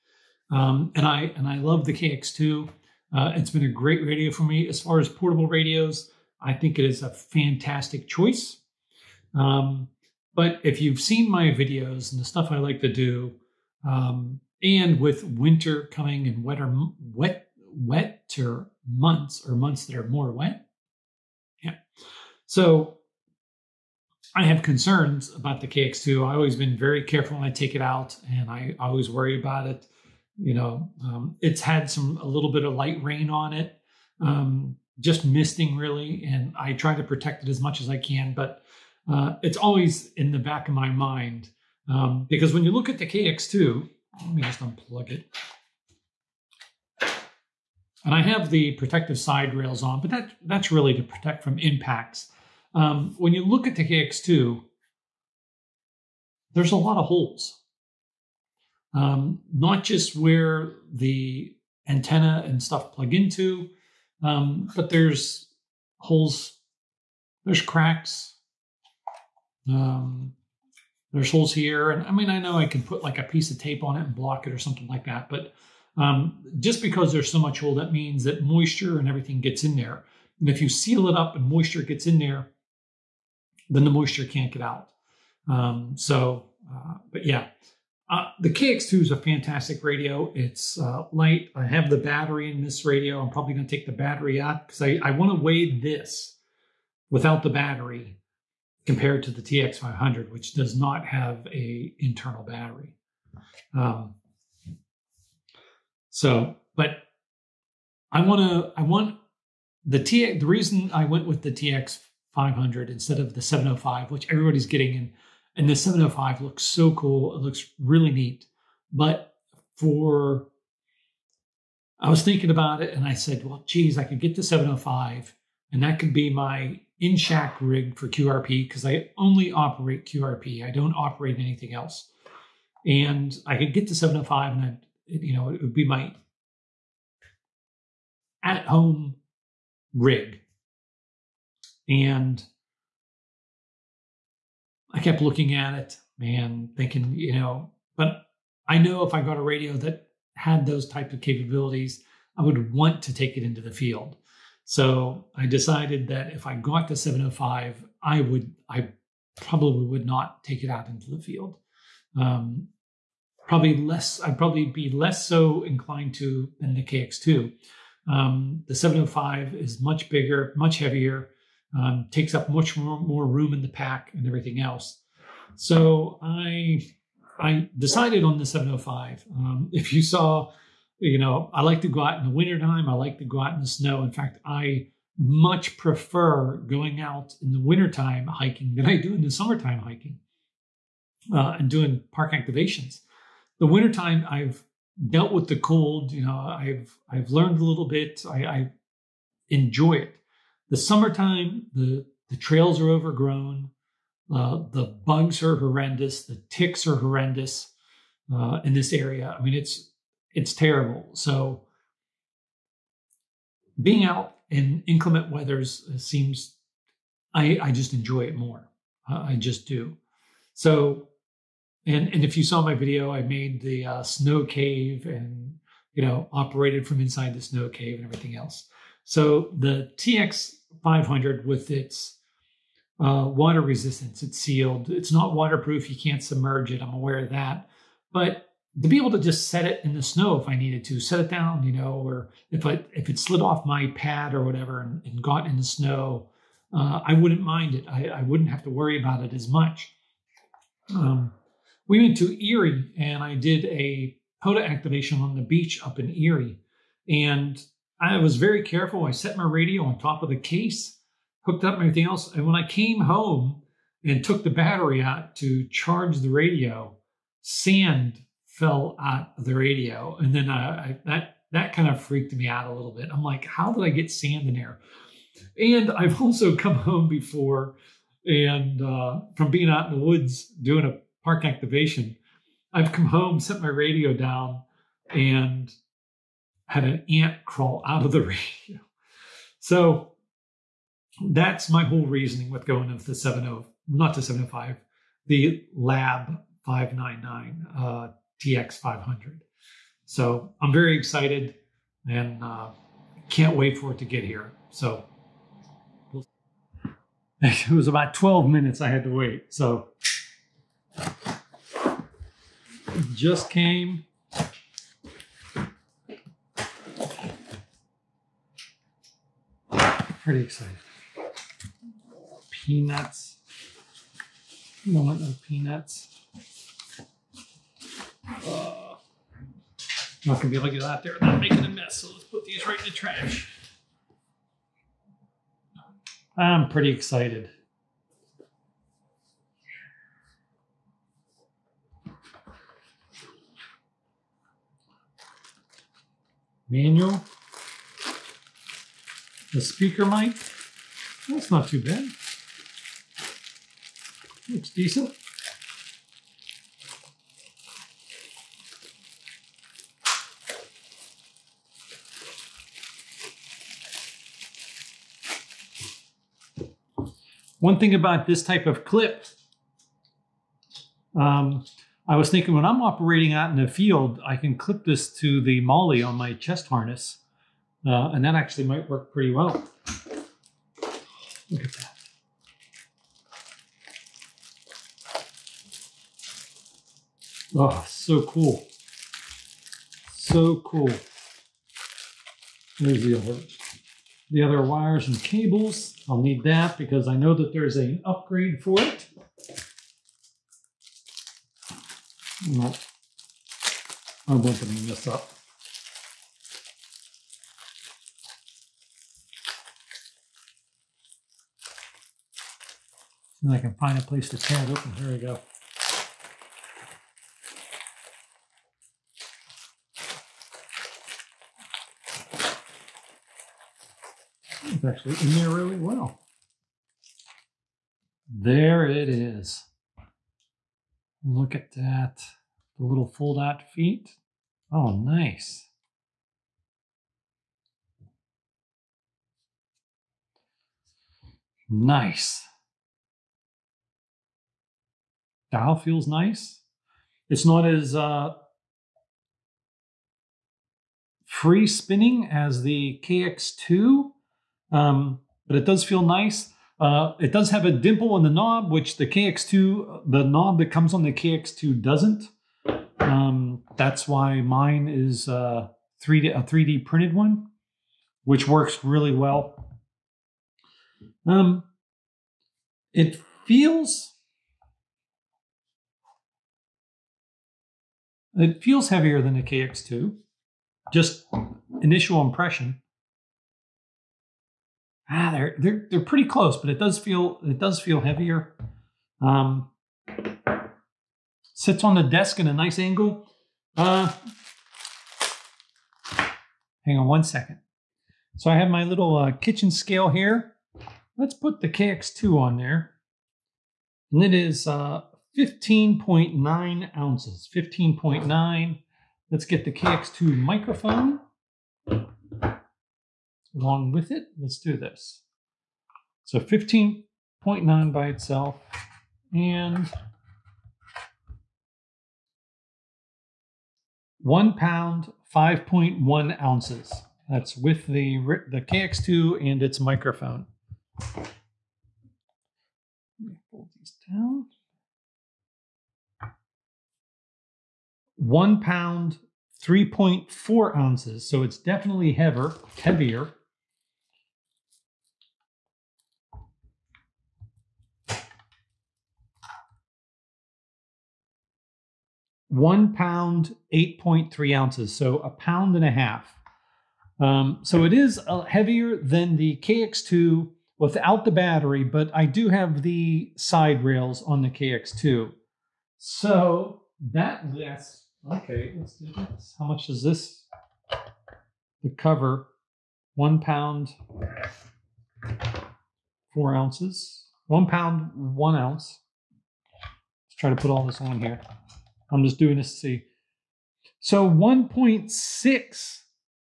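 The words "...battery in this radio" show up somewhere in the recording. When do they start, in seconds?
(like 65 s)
91 s.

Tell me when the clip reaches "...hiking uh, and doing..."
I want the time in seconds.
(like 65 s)
189 s.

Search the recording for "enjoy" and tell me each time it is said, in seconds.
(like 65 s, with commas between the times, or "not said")
199 s, 217 s.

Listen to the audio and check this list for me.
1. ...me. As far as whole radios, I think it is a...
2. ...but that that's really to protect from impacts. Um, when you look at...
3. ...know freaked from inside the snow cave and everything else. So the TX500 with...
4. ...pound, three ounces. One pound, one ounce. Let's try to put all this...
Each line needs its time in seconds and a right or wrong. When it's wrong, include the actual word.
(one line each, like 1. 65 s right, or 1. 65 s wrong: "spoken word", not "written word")
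1. 4 s wrong: "portable", not "whole"
2. 50 s right
3. 226 s wrong: "operated", not "freaked"
4. 573 s wrong: "four", not "three".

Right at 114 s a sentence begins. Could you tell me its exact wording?
And, and the 705 looks so cool.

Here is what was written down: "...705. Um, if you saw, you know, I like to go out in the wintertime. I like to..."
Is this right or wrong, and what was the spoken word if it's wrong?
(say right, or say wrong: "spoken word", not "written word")
right.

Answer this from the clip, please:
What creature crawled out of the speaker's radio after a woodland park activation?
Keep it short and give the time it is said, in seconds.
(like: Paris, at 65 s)
An ant, at 287 s.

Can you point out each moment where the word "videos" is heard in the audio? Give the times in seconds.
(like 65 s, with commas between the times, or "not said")
11 s, 222 s.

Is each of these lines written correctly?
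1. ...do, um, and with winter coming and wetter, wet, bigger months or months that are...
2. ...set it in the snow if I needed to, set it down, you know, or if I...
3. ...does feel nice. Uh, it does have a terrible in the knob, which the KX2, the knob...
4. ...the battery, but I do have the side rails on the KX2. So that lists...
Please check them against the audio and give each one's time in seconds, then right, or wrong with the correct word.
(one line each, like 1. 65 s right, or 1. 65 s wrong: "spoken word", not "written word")
1. 12 s wrong: "wetter", not "bigger"
2. 239 s right
3. 455 s wrong: "dimple", not "terrible"
4. 561 s right.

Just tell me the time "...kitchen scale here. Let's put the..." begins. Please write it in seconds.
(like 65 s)
499 s.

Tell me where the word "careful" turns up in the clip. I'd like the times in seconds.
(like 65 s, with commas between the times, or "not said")
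27 s, 258 s.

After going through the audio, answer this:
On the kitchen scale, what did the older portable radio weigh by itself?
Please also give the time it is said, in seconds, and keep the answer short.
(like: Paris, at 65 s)
15.9 ounces, at 505 s.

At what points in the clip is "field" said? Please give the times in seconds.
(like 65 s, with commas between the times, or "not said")
153 s, 161 s, 373 s.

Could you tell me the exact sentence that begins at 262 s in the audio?
And when I came home and took the battery out to charge the radio, sand fell out of the radio.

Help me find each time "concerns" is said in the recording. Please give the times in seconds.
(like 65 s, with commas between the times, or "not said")
24 s.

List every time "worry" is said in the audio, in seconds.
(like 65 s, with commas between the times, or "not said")
29 s, 248 s.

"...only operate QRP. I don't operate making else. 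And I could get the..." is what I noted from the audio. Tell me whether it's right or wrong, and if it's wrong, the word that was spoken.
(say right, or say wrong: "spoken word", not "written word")
wrong: "anything", not "making".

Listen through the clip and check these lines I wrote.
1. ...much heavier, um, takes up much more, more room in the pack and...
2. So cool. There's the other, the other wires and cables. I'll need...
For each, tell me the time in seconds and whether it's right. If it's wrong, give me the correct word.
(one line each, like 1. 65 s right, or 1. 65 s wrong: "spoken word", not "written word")
1. 170 s right
2. 390 s right.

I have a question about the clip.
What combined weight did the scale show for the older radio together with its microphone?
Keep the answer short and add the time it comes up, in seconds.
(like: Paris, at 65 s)
1 pound 5.1 ounces, at 524 s.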